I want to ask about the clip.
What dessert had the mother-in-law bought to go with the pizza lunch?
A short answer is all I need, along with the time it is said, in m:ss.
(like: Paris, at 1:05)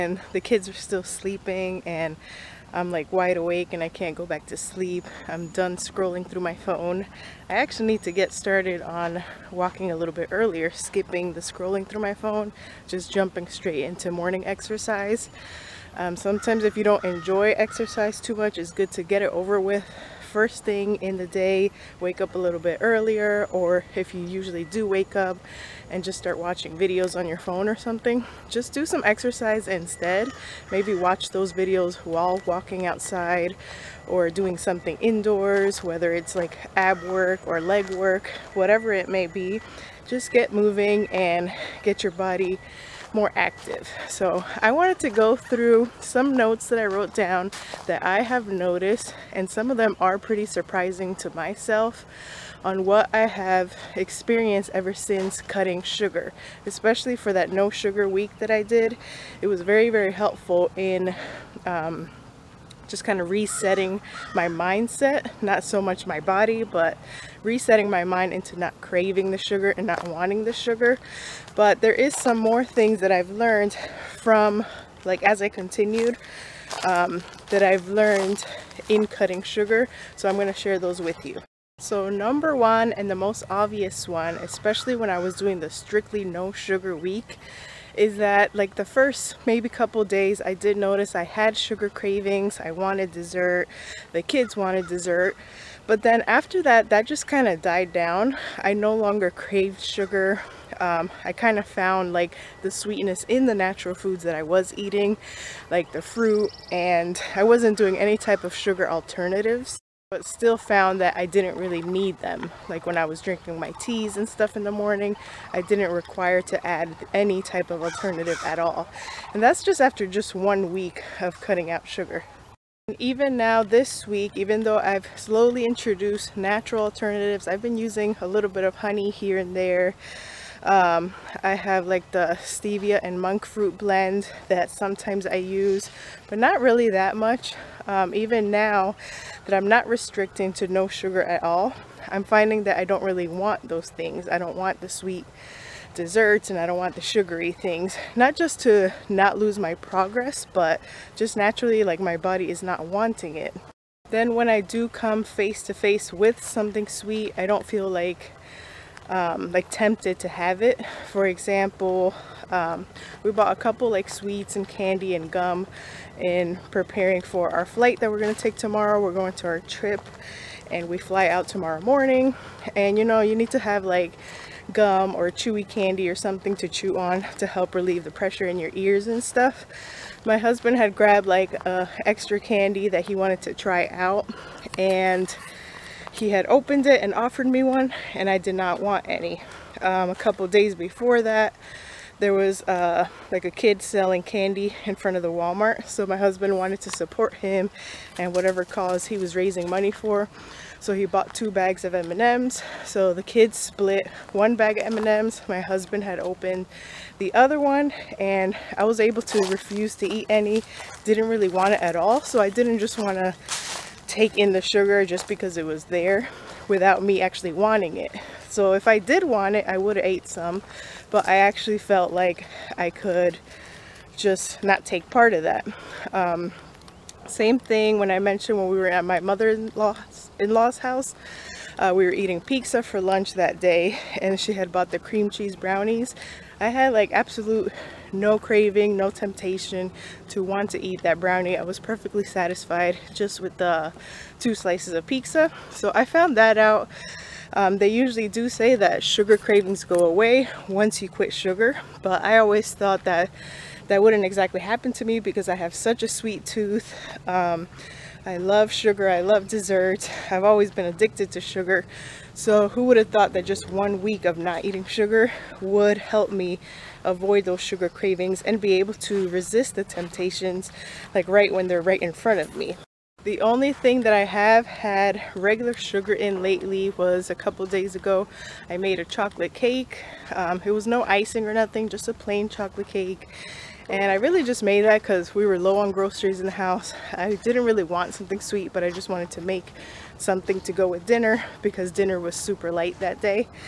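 cream cheese brownies, at 3:54.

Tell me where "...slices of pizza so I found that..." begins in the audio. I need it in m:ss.
4:04.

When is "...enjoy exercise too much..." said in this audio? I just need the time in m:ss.
0:17.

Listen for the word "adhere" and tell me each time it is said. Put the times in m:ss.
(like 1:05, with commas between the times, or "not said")
not said.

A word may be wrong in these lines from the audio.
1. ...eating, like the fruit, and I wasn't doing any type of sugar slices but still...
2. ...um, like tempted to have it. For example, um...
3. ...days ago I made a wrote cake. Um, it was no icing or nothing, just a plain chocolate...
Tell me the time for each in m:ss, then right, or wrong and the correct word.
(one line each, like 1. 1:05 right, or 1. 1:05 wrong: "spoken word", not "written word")
1. 1:44 wrong: "alternatives", not "slices"
2. 2:39 right
3. 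4:37 wrong: "chocolate", not "wrote".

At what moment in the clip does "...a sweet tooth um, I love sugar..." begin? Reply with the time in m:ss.
4:16.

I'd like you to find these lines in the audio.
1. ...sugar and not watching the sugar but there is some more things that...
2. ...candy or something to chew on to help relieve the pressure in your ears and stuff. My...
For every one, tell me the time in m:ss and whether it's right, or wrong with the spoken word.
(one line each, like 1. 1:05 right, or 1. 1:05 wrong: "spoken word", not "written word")
1. 1:09 wrong: "wanting", not "watching"
2. 2:55 right.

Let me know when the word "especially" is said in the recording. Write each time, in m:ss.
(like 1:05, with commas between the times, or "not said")
0:56, 1:24.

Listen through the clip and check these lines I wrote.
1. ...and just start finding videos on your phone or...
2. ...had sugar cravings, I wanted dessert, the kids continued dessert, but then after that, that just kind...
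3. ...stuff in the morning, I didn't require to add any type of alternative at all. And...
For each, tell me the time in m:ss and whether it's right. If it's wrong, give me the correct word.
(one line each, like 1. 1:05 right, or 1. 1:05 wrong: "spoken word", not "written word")
1. 0:25 wrong: "watching", not "finding"
2. 1:31 wrong: "wanted", not "continued"
3. 1:54 right.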